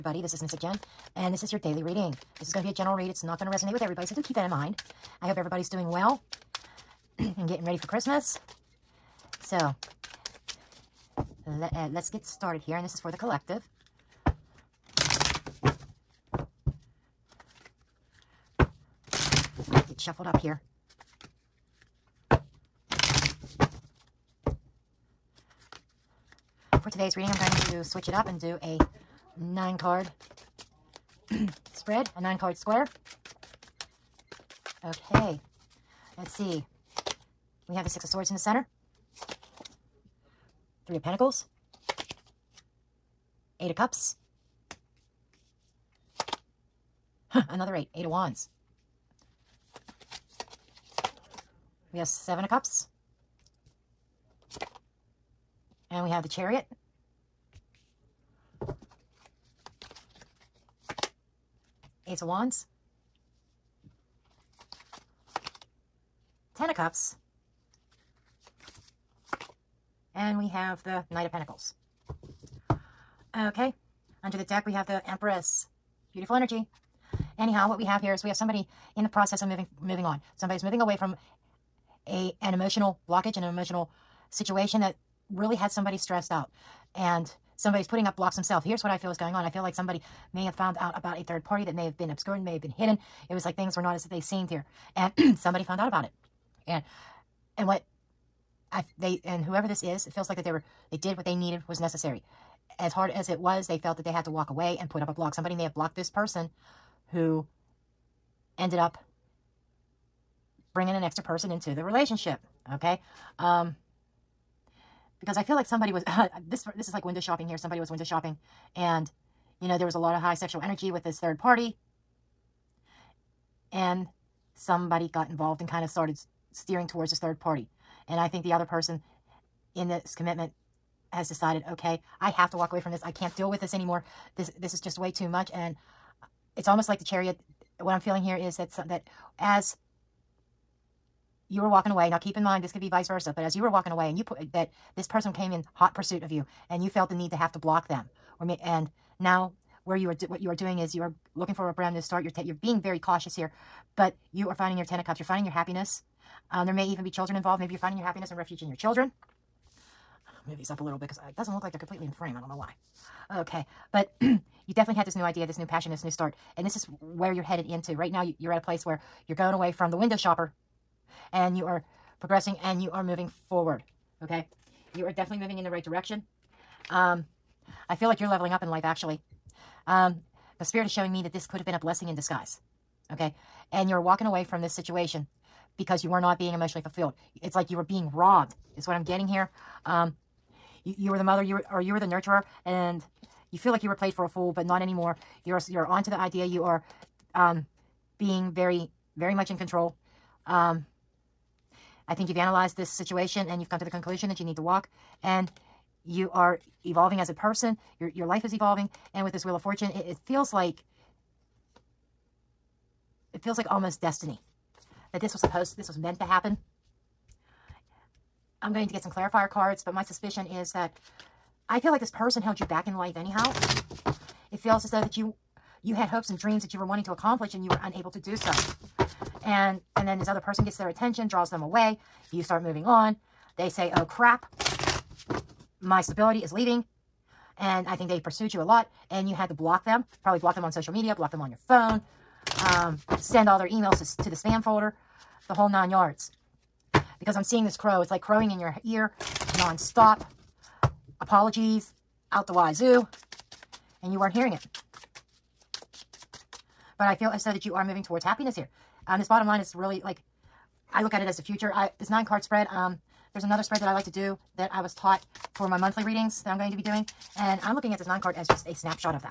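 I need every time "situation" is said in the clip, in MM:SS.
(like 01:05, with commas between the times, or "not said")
01:24, 03:04, 03:22.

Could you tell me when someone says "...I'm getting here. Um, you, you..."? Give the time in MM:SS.
03:08.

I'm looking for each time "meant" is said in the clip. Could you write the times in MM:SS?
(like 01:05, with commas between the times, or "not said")
03:35.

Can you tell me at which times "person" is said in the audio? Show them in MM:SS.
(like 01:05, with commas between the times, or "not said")
01:46, 01:51, 02:08, 02:25, 03:27, 03:42, 03:50.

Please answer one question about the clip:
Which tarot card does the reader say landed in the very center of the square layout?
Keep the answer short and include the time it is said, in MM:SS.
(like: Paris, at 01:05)
Six of Swords, at 00:37.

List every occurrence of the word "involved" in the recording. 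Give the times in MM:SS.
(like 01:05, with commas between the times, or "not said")
02:05, 02:37.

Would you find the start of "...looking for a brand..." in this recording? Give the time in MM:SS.
02:31.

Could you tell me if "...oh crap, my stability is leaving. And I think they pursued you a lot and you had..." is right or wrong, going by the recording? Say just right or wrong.
right.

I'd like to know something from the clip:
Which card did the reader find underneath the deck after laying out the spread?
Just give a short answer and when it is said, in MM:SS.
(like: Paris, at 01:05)
The Empress, at 01:14.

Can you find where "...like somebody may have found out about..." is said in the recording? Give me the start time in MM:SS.
01:29.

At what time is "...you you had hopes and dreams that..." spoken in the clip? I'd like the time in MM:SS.
03:45.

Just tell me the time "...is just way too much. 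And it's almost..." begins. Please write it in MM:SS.
02:14.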